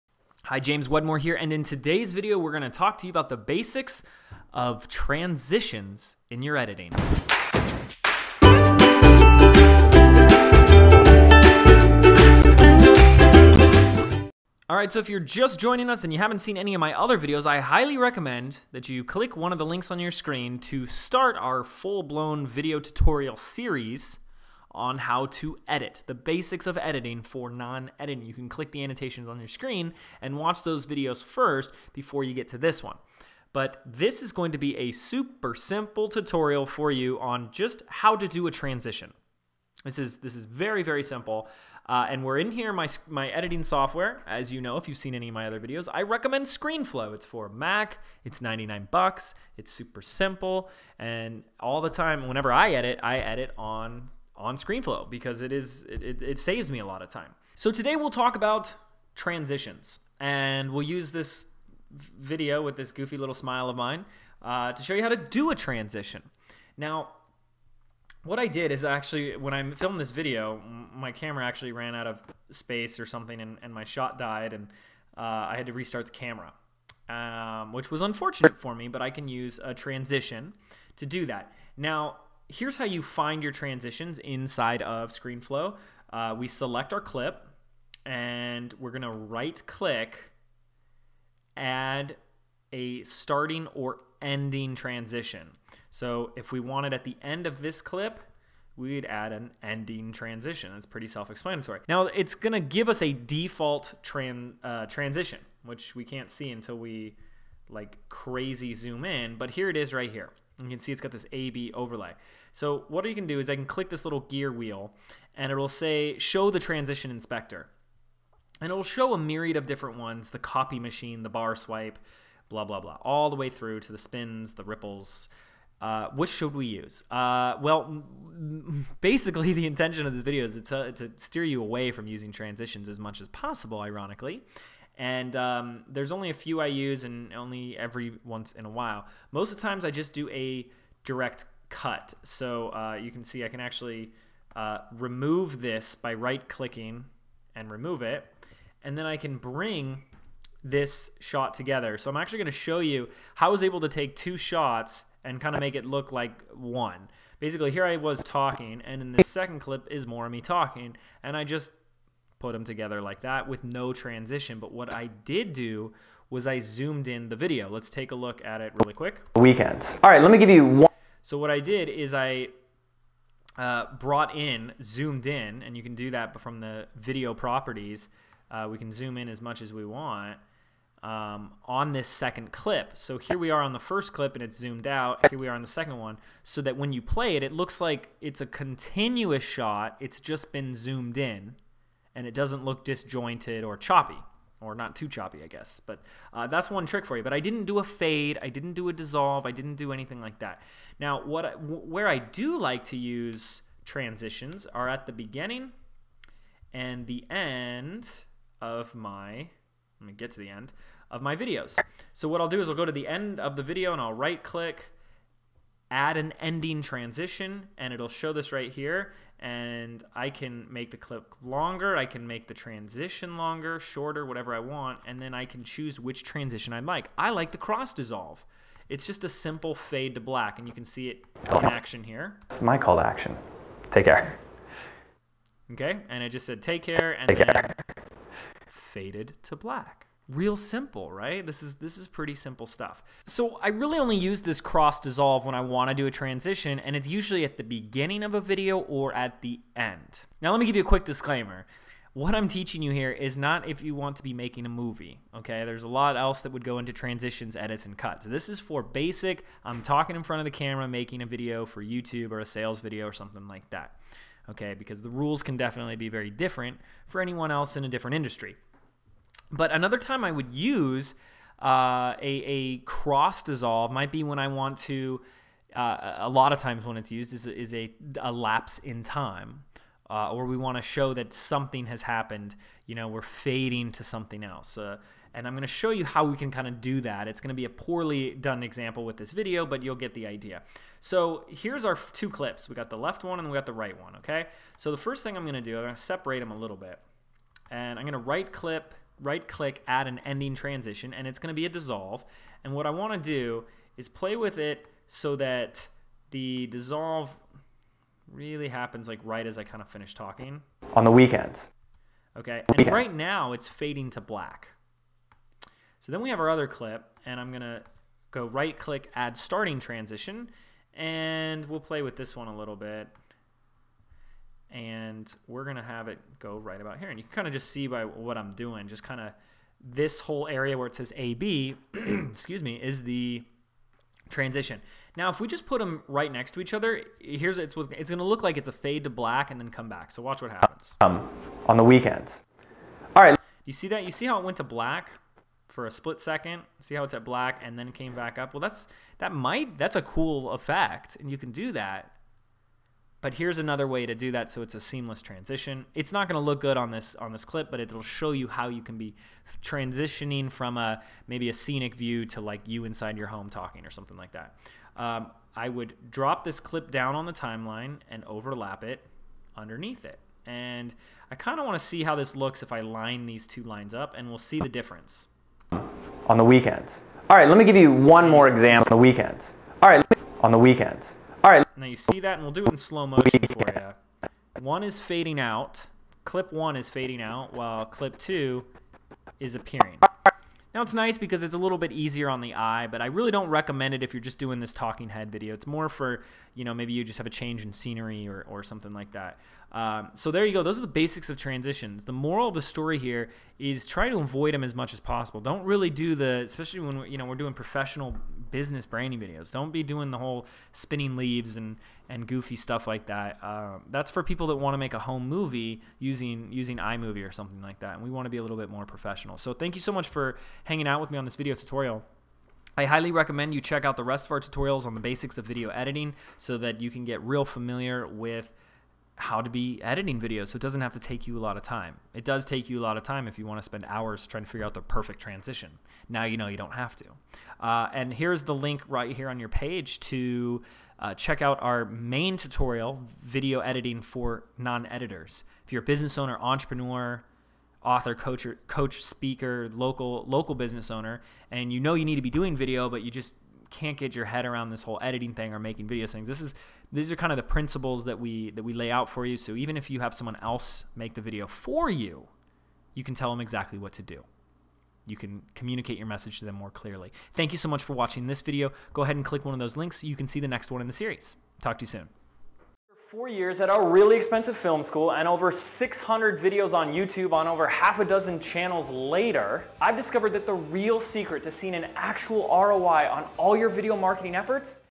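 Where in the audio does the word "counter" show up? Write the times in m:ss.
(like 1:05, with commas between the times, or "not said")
not said.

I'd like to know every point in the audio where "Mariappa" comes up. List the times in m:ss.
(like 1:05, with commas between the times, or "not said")
not said.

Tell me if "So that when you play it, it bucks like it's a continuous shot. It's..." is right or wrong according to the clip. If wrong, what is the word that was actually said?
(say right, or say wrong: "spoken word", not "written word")
wrong: "looks", not "bucks".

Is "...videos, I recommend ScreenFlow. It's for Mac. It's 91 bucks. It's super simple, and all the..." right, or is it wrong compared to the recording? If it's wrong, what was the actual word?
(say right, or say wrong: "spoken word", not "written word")
wrong: "99", not "91".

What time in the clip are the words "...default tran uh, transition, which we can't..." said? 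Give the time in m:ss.
1:43.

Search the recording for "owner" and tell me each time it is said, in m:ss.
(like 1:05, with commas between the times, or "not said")
7:26, 7:30.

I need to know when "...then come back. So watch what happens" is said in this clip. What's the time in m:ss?
5:39.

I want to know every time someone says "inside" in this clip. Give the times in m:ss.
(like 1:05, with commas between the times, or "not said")
1:24, 6:02.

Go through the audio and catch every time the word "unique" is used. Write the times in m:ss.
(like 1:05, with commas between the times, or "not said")
not said.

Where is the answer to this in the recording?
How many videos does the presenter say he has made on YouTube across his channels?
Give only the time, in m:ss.
7:55.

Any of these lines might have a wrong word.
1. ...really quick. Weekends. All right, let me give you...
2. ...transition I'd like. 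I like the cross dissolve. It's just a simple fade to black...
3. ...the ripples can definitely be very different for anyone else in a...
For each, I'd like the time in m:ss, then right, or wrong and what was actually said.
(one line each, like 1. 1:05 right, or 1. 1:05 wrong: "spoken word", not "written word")
1. 2:48 right
2. 3:46 right
3. 4:25 wrong: "rules", not "ripples".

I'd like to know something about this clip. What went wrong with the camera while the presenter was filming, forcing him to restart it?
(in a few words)
ran out of space.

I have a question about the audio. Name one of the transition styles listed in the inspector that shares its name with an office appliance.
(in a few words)
copy machine.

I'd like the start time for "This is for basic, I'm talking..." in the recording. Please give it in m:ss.
4:18.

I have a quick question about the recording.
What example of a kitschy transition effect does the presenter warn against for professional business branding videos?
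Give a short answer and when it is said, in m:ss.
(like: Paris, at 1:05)
spinning leaves, at 6:50.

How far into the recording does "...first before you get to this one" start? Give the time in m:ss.
0:31.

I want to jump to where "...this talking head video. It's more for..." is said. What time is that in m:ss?
6:34.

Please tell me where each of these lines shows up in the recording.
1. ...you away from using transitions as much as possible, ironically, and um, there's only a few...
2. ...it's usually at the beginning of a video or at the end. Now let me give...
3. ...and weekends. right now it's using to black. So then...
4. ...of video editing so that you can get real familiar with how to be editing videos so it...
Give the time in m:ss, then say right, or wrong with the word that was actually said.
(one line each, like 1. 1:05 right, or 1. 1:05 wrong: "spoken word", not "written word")
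1. 2:11 right
2. 4:06 right
3. 5:12 wrong: "fading", not "using"
4. 7:05 right.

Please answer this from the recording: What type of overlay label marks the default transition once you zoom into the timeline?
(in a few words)
AB overlay.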